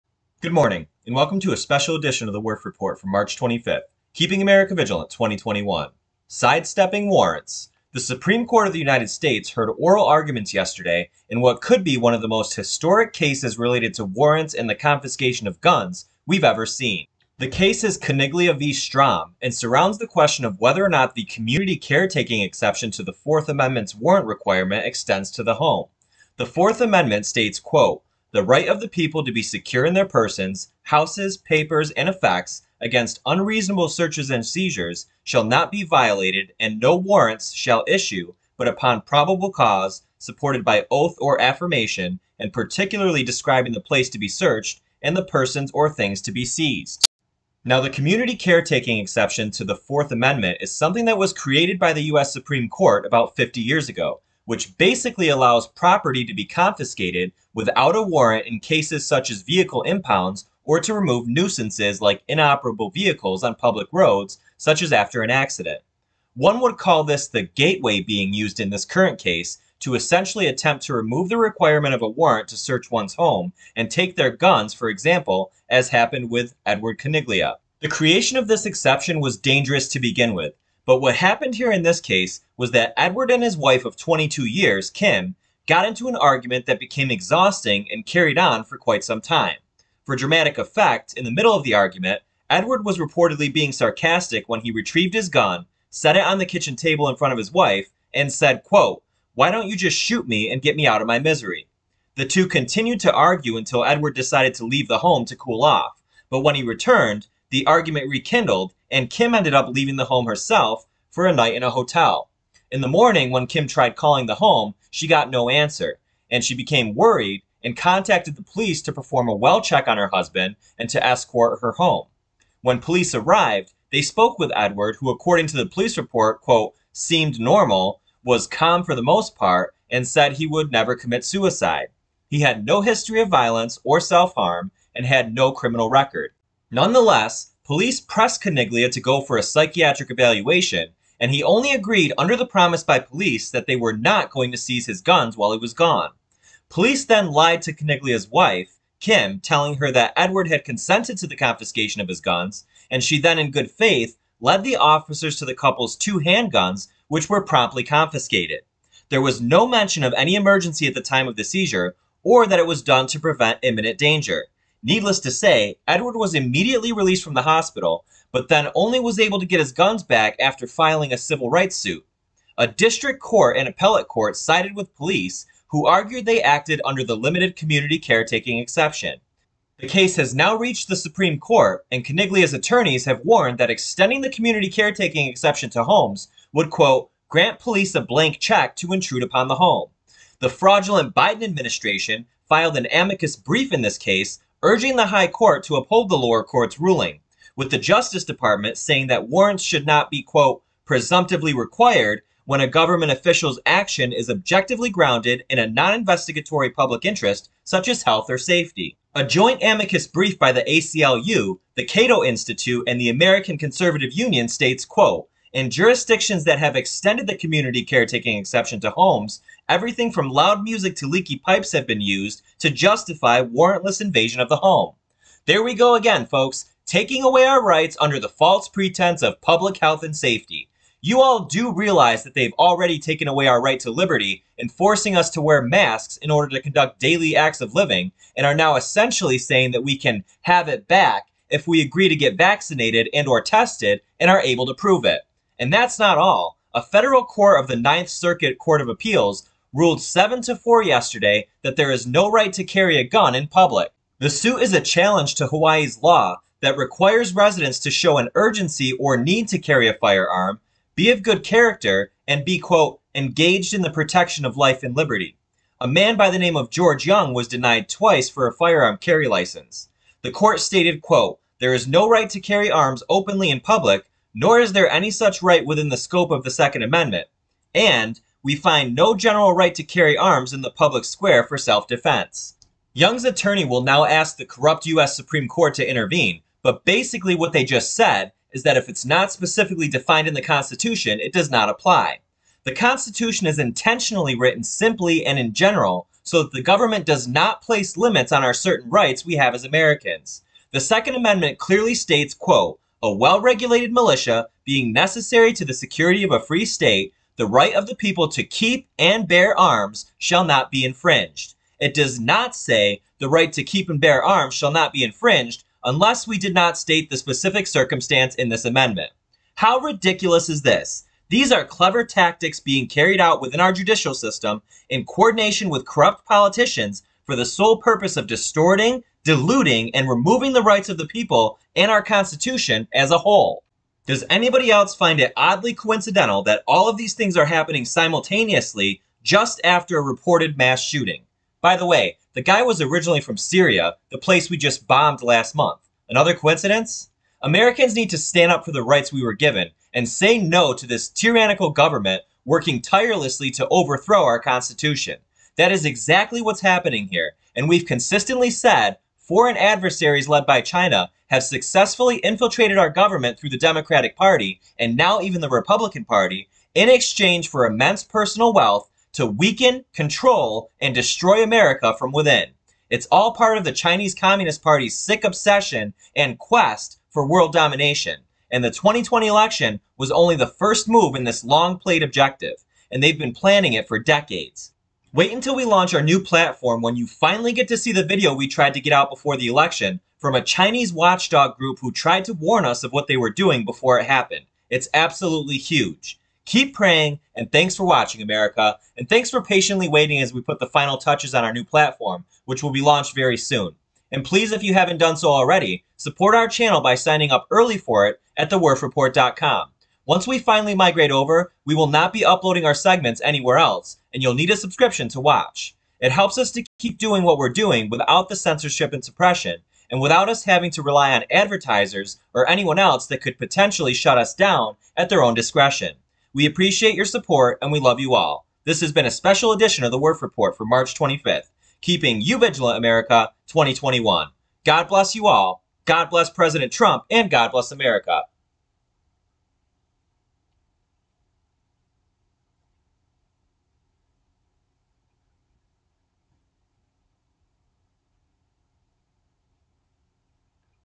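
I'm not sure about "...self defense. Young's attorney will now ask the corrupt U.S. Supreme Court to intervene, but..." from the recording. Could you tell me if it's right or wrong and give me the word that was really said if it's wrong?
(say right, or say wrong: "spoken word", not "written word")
right.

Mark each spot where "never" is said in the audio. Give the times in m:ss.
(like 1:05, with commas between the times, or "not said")
2:10.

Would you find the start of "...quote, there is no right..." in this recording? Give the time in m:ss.
4:31.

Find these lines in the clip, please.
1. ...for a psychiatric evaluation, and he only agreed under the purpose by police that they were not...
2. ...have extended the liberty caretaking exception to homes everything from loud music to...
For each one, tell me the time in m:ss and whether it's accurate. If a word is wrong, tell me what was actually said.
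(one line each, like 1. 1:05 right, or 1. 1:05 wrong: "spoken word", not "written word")
1. 2:19 wrong: "promise", not "purpose"
2. 3:36 wrong: "community", not "liberty".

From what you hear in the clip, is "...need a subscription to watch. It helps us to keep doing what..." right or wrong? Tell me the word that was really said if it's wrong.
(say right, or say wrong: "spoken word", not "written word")
right.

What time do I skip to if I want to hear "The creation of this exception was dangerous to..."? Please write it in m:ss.
1:17.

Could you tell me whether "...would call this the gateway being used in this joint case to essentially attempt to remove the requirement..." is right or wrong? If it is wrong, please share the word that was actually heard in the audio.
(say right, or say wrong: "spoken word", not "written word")
wrong: "current", not "joint".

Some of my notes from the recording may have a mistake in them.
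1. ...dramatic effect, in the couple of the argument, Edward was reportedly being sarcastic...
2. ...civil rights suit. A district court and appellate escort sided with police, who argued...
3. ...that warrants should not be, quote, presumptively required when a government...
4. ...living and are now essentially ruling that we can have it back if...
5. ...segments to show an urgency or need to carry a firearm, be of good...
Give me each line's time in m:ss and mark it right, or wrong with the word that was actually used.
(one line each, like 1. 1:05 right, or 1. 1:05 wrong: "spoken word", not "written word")
1. 1:30 wrong: "middle", not "couple"
2. 2:51 wrong: "court", not "escort"
3. 3:19 right
4. 3:57 wrong: "saying", not "ruling"
5. 4:17 wrong: "residents", not "segments".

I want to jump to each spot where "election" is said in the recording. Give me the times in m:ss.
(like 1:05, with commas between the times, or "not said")
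6:19, 6:29.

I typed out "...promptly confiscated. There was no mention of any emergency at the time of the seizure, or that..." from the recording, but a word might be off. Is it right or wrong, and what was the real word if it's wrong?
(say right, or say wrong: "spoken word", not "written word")
right.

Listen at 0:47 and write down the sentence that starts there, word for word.
Now, the community caretaking exception to the Fourth Amendment is something that was created by the U.S.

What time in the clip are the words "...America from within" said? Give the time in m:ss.
6:11.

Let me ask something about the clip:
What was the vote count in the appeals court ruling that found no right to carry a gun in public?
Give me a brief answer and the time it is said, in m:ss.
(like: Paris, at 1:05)
7 to 4, at 4:10.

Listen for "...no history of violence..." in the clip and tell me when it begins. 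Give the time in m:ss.
2:12.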